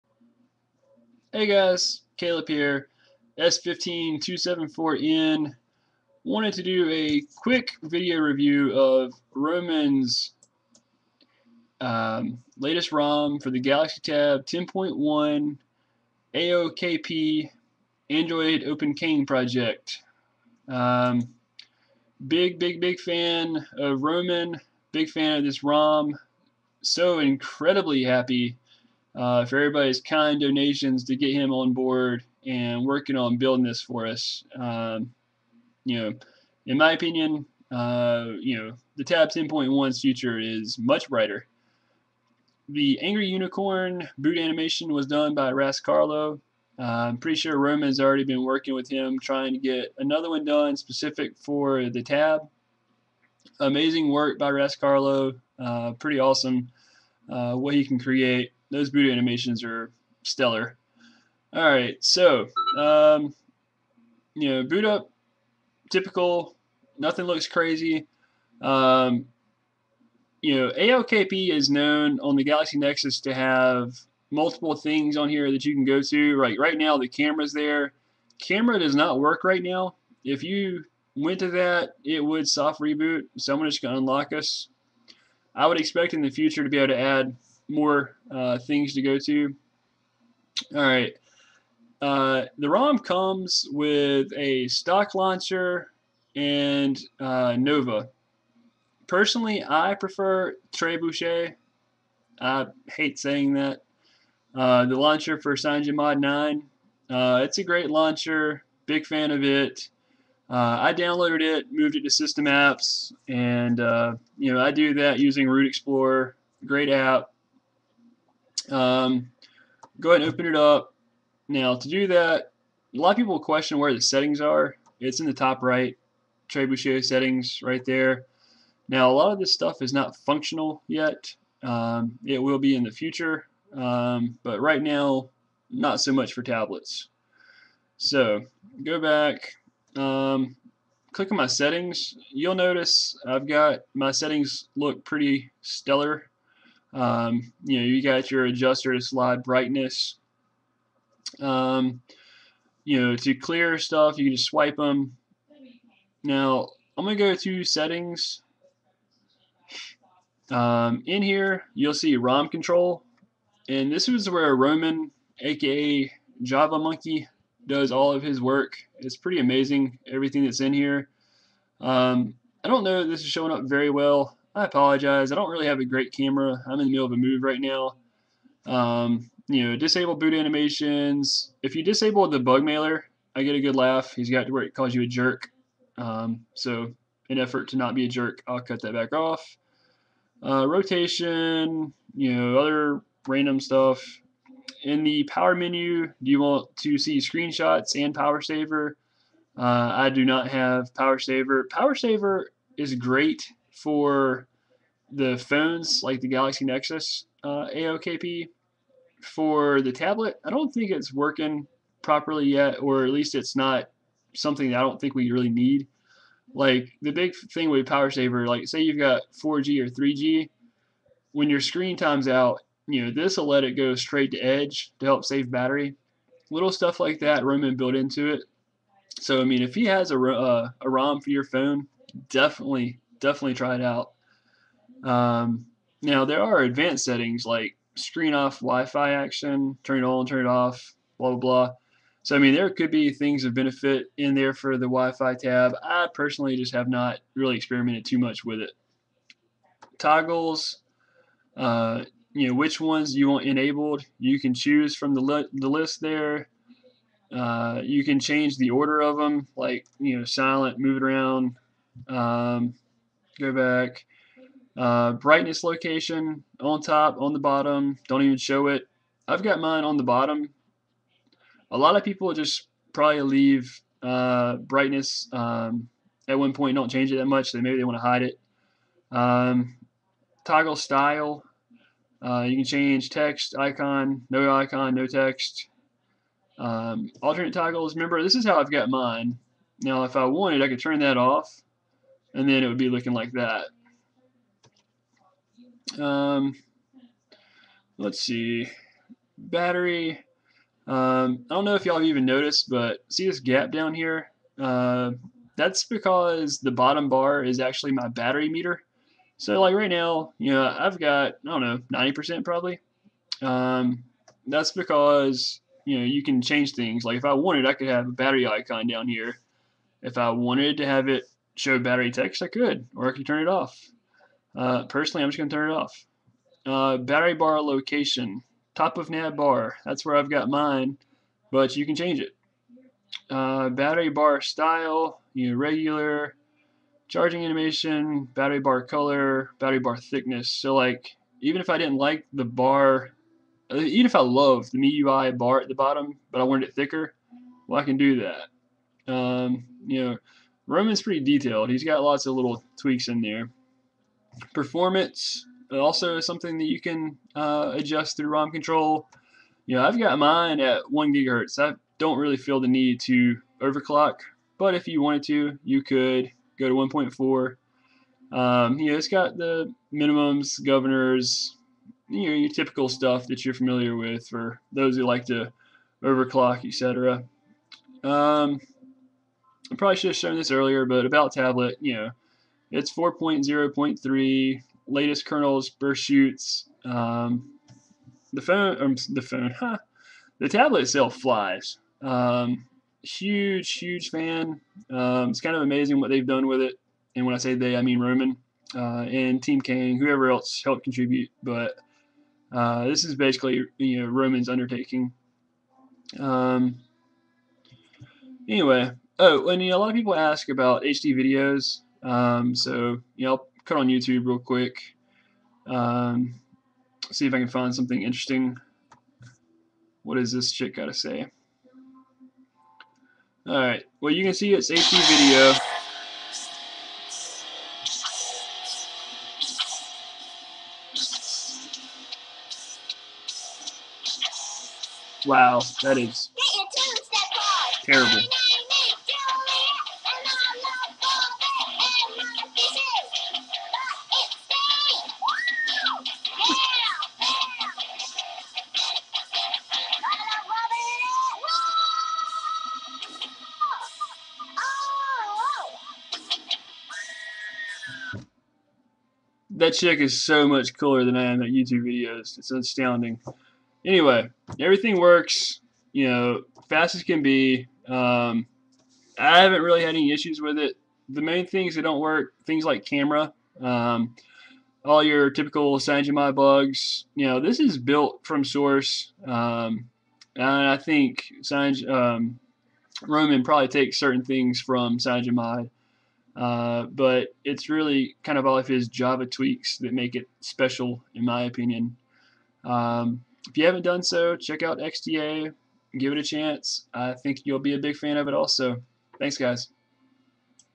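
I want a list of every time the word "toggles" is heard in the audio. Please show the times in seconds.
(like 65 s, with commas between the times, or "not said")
249 s, 280 s, 287 s.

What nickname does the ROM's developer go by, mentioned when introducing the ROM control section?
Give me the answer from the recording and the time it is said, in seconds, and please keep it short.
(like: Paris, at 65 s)
Java Monkey, at 166 s.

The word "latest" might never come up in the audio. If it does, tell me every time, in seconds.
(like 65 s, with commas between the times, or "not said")
12 s, 384 s.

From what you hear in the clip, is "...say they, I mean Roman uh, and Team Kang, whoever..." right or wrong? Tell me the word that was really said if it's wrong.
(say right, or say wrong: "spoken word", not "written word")
right.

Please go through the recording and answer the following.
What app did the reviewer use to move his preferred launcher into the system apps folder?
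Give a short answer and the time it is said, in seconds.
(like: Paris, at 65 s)
Root Explorer, at 115 s.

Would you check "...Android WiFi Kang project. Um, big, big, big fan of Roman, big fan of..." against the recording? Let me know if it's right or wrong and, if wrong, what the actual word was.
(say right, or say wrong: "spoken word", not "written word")
wrong: "Open", not "WiFi".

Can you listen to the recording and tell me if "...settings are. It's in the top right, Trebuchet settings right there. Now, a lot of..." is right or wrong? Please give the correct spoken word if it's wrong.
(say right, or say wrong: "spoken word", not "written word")
right.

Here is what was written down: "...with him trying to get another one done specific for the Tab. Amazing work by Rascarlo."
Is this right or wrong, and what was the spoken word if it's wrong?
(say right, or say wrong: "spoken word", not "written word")
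right.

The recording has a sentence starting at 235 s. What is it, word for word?
Um, now there are advanced settings like screen off Wi-Fi action, turn it on, turn it off, blah blah blah.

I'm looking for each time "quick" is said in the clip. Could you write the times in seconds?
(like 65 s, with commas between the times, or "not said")
7 s, 414 s.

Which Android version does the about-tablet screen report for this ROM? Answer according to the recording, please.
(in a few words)
4.0.3.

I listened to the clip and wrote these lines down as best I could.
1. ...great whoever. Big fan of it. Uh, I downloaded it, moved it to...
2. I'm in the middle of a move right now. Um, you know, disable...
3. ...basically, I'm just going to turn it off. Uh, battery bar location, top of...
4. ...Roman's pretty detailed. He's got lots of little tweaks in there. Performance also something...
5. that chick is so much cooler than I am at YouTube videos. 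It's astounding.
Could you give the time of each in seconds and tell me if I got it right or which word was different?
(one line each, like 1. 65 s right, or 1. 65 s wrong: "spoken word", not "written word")
1. 107 s wrong: "launcher", not "whoever"
2. 176 s right
3. 324 s wrong: "personally", not "basically"
4. 350 s right
5. 459 s right.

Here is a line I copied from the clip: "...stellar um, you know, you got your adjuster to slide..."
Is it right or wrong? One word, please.
right.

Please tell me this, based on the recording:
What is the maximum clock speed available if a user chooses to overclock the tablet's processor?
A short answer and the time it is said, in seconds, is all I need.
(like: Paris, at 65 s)
1.4 GHz, at 366 s.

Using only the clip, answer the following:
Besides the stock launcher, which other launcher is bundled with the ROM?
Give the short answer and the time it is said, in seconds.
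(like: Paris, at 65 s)
Nova, at 97 s.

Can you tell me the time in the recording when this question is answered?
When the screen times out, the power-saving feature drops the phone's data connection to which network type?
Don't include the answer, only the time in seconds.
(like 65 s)
224 s.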